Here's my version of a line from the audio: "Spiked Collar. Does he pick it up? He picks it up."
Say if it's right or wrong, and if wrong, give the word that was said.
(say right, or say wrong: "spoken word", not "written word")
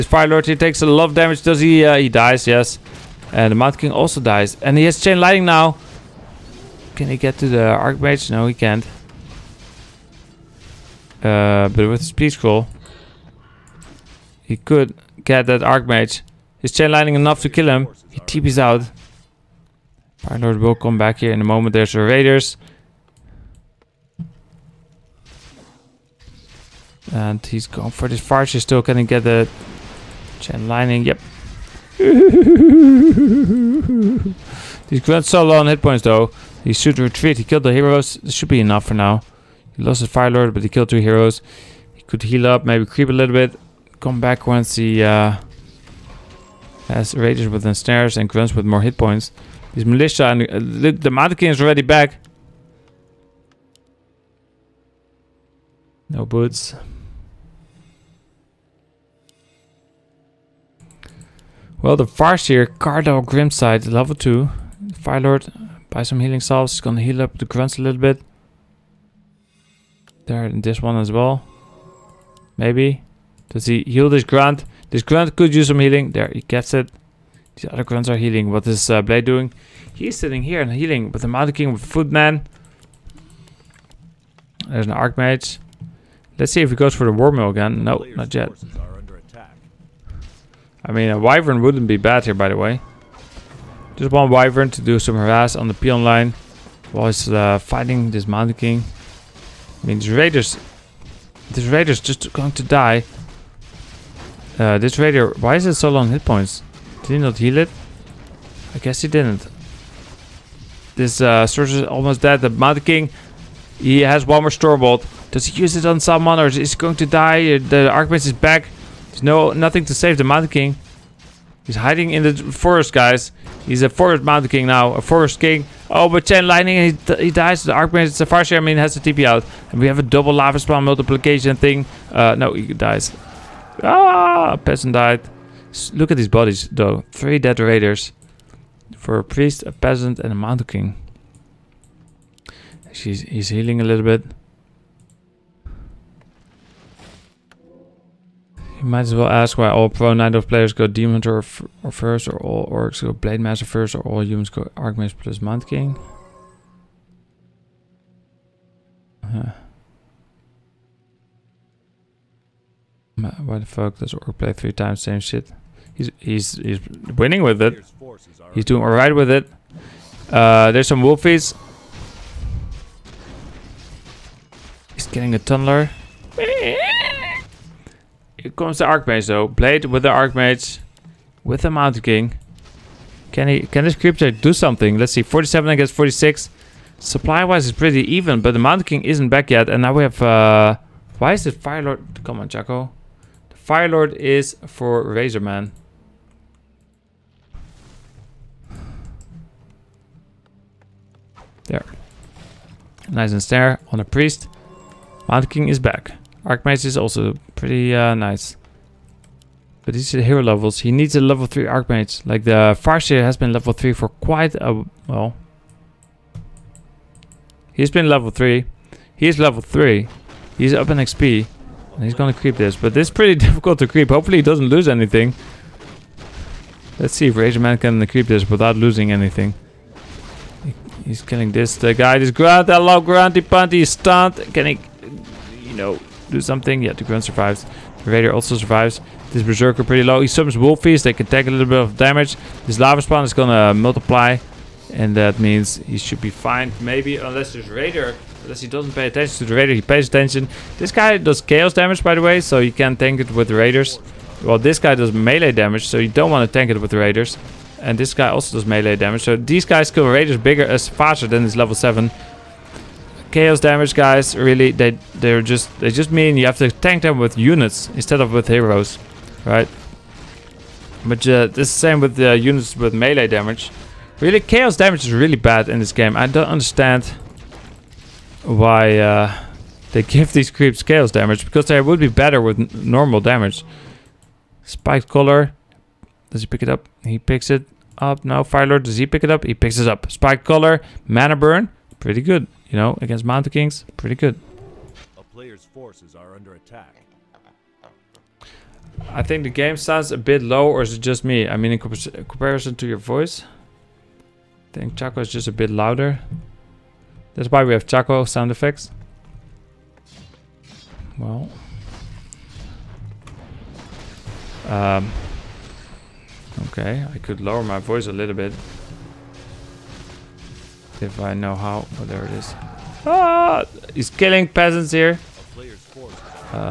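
right.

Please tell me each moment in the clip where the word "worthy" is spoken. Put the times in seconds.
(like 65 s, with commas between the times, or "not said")
not said.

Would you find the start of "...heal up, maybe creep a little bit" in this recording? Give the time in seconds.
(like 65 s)
42 s.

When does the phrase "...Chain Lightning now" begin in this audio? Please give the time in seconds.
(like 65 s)
4 s.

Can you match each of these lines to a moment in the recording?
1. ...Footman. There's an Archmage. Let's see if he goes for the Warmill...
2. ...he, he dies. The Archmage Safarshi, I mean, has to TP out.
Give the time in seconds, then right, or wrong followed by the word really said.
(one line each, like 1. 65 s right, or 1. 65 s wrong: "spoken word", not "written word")
1. 81 s right
2. 127 s right.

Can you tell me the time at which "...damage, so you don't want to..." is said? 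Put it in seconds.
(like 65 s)
255 s.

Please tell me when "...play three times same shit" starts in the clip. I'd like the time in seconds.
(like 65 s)
164 s.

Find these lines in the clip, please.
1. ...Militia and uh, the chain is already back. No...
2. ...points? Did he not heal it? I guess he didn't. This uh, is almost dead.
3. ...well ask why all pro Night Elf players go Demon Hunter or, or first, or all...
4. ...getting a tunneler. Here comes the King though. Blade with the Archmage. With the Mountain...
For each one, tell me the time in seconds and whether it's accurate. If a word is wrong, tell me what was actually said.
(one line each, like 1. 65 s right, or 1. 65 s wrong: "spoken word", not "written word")
1. 49 s wrong: "mannequin", not "chain"
2. 106 s right
3. 149 s right
4. 175 s wrong: "Archmage", not "King".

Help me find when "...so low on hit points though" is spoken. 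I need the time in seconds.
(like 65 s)
35 s.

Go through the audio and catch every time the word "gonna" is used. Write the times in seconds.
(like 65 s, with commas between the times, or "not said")
66 s, 222 s, 243 s.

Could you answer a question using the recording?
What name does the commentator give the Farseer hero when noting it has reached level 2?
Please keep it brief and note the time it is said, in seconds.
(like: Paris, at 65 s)
Cardal Grimside, at 62 s.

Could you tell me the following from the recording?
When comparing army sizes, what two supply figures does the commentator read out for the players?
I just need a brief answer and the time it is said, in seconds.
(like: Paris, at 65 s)
47 against 46, at 185 s.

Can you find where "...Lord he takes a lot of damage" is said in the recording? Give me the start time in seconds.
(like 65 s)
0 s.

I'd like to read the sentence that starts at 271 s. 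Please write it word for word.
But uh, this same with the uh, units with melee damage.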